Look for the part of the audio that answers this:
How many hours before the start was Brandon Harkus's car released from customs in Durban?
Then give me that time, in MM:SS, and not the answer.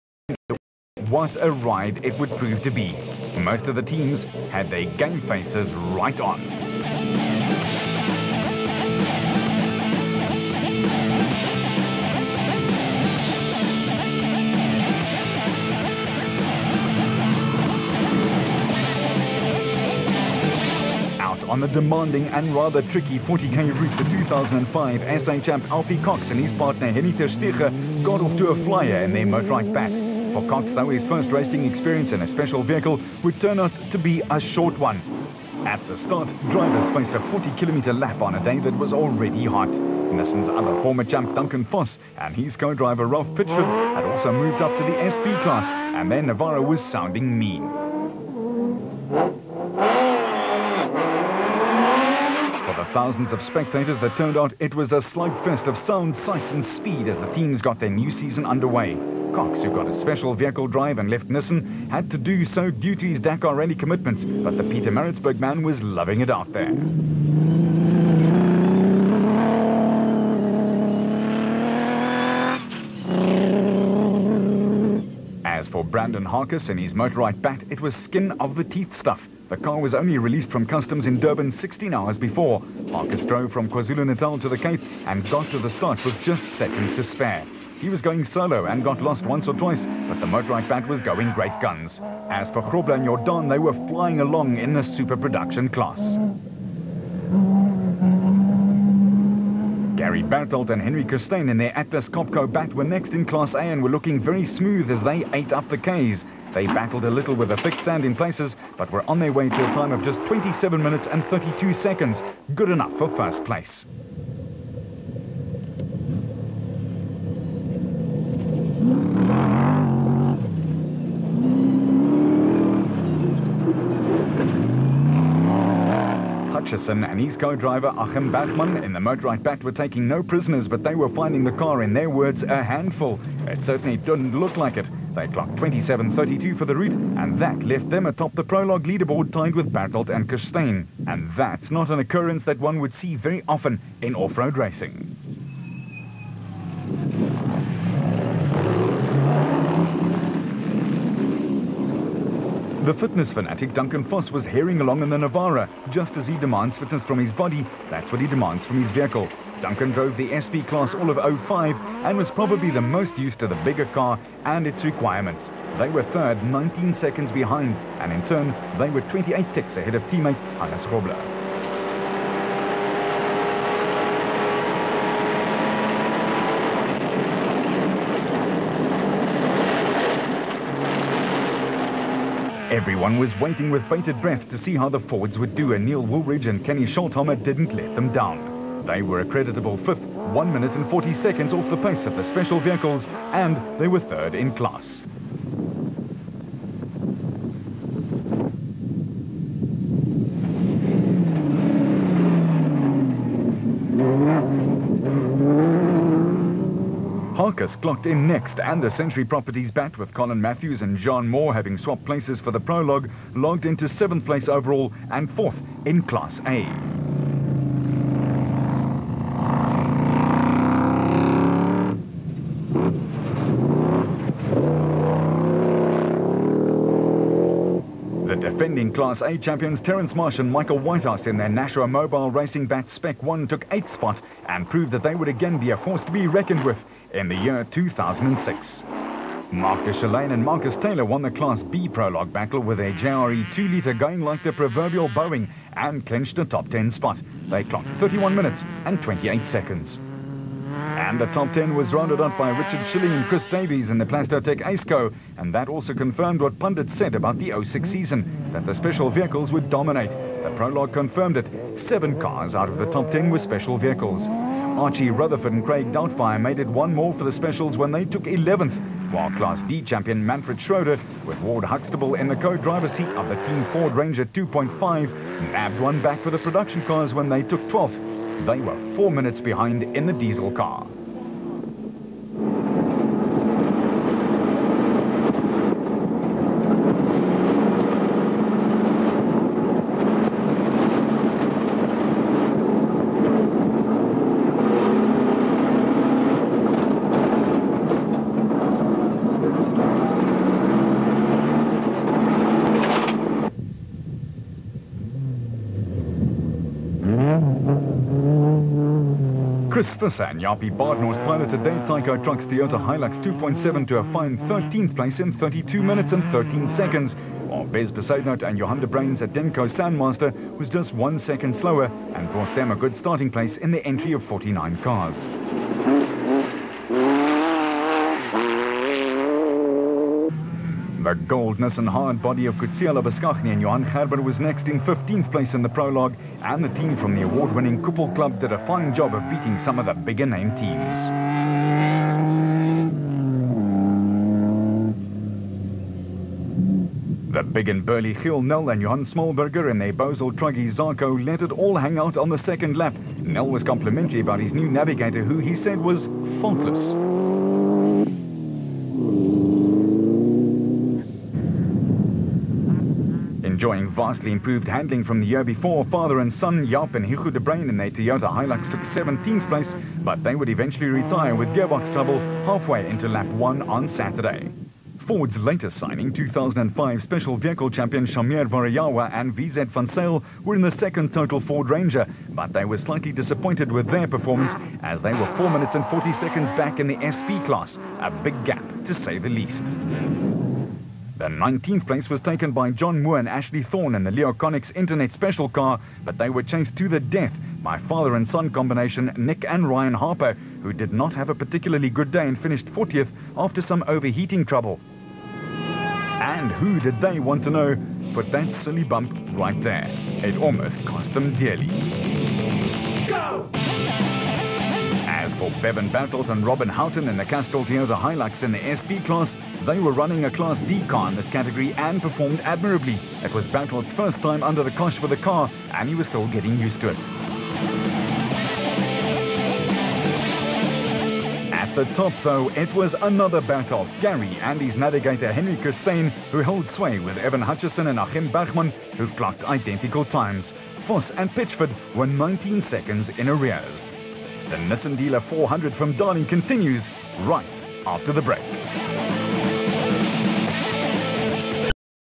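01:21.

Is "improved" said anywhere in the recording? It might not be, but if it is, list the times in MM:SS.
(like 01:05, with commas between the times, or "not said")
06:04.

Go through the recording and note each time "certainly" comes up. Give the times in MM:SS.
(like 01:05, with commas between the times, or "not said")
02:13.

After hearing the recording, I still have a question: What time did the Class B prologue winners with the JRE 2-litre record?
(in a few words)
31 minutes 28 seconds.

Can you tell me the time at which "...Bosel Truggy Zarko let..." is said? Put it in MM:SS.
05:49.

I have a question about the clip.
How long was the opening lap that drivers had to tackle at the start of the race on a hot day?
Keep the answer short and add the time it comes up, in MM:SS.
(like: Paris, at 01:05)
40 kilometers, at 00:37.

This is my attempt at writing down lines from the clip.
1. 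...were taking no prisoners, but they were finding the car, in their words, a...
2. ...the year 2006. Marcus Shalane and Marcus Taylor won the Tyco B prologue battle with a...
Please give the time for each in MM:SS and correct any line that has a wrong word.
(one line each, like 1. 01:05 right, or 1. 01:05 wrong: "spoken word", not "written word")
1. 02:09 right
2. 03:57 wrong: "Class", not "Tyco".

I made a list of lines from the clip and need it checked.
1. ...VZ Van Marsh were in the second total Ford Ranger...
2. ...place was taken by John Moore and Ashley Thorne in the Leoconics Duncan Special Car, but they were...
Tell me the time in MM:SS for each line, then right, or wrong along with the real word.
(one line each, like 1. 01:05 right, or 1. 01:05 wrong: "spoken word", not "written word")
1. 06:19 wrong: "Sale", not "Marsh"
2. 06:31 wrong: "Internet", not "Duncan".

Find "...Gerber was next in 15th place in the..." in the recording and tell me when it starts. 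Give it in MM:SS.
05:33.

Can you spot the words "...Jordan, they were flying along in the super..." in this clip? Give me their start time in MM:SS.
01:33.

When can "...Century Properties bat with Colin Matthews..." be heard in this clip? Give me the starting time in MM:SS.
03:28.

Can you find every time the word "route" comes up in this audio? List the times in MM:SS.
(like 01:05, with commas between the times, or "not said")
00:23, 02:16.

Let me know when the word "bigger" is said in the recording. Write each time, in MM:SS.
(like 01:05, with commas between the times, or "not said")
02:43, 05:39.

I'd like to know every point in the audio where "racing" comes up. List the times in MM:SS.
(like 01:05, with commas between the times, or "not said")
00:31, 02:24, 03:52.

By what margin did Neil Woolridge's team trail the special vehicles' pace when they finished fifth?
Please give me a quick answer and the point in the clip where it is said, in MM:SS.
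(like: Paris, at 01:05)
1 minute 40 seconds, at 03:09.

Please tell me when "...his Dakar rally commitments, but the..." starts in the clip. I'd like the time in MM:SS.
01:03.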